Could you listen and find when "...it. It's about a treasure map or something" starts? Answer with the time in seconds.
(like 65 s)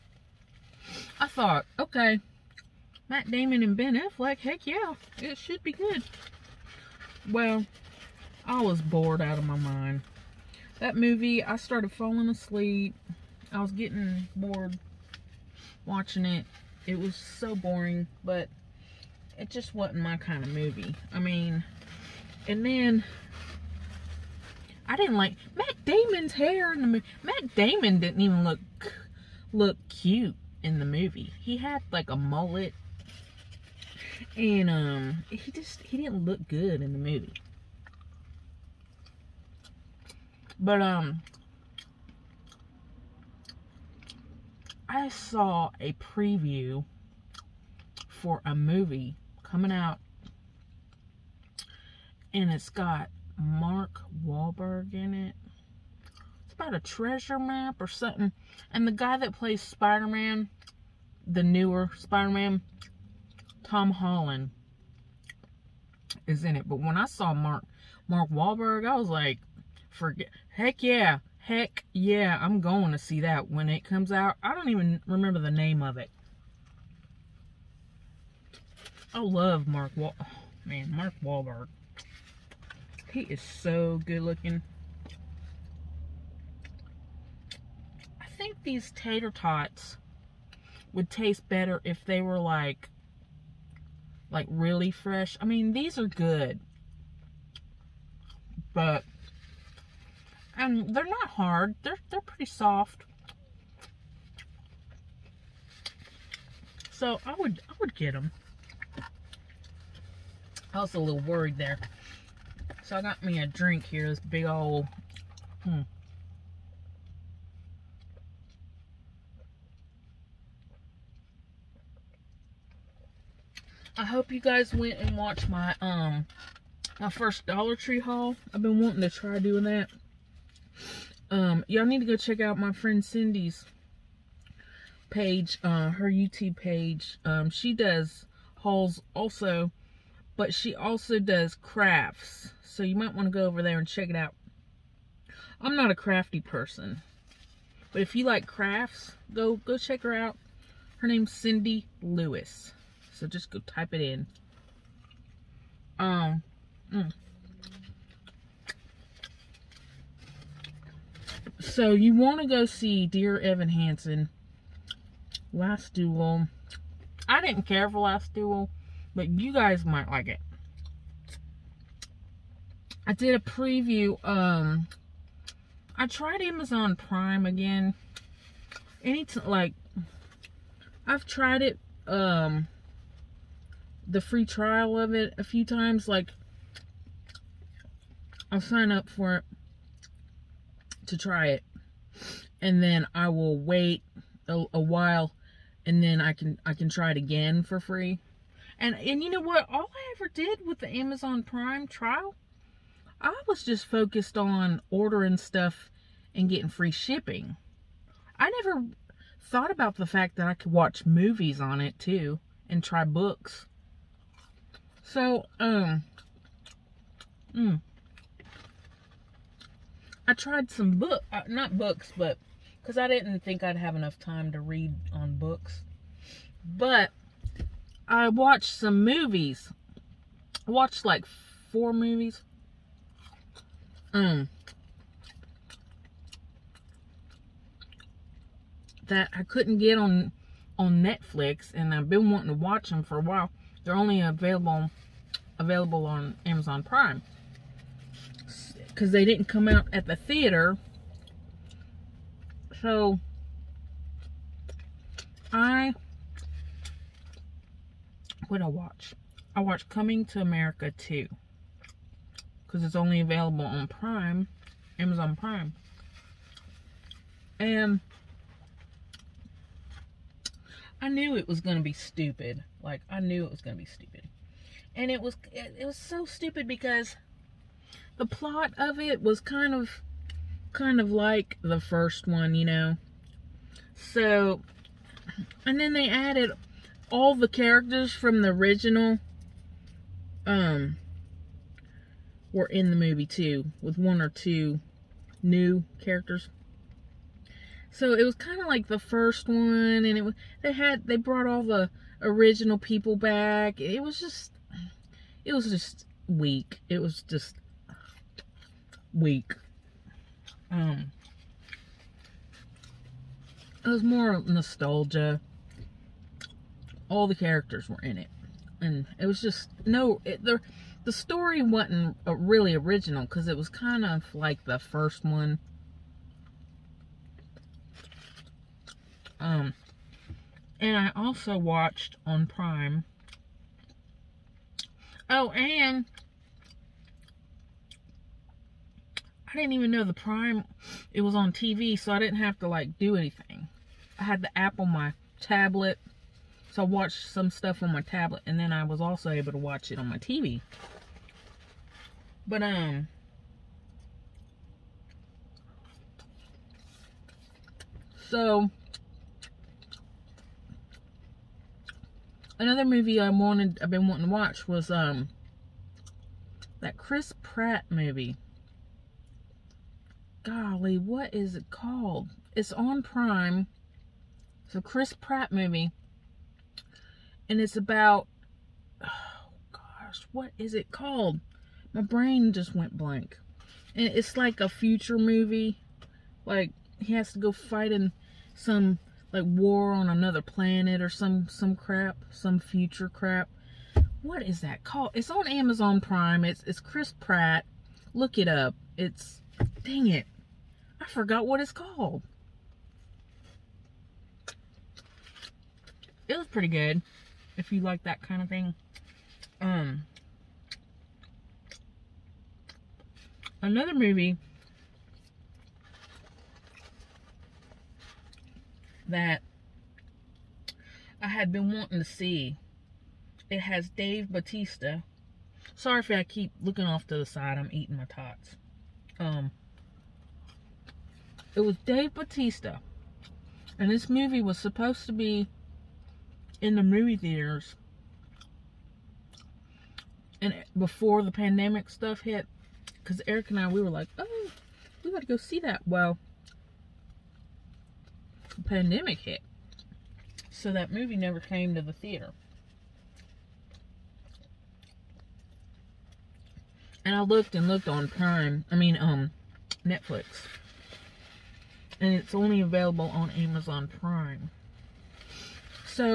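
55 s.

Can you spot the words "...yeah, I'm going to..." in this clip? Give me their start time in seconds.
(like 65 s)
71 s.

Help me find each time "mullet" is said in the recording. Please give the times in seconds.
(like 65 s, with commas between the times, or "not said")
32 s.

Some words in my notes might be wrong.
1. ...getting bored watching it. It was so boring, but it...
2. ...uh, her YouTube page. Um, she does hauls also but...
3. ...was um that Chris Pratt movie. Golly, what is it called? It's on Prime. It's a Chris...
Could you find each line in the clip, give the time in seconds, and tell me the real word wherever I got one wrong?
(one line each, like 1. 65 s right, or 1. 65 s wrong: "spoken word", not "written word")
1. 13 s right
2. 135 s right
3. 364 s right.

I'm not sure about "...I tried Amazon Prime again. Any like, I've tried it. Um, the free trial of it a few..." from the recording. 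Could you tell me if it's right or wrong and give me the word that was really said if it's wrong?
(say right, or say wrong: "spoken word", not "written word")
right.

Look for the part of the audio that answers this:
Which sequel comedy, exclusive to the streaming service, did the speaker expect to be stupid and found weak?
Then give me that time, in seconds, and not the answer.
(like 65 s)
259 s.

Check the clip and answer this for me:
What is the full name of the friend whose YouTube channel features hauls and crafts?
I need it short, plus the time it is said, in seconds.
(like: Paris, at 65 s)
Cindy Lewis, at 151 s.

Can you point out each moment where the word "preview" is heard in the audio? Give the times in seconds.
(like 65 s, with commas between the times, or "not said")
45 s, 173 s.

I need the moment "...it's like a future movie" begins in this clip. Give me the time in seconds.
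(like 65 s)
384 s.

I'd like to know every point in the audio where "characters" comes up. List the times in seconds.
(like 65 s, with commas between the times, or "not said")
287 s, 296 s, 317 s.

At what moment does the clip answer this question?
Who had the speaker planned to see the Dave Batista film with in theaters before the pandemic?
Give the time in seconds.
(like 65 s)
443 s.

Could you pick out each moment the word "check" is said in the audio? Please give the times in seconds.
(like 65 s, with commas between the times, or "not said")
132 s, 143 s, 149 s.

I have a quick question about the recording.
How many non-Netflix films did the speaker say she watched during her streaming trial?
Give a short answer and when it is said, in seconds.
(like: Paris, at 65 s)
4, at 231 s.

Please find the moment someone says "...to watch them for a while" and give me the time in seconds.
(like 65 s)
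242 s.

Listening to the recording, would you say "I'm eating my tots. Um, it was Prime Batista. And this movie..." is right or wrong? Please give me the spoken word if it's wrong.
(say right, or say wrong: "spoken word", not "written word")
wrong: "Dave", not "Prime".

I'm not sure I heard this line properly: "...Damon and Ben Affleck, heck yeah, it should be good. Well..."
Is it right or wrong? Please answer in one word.
right.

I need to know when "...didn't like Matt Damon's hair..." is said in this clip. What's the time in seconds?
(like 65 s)
24 s.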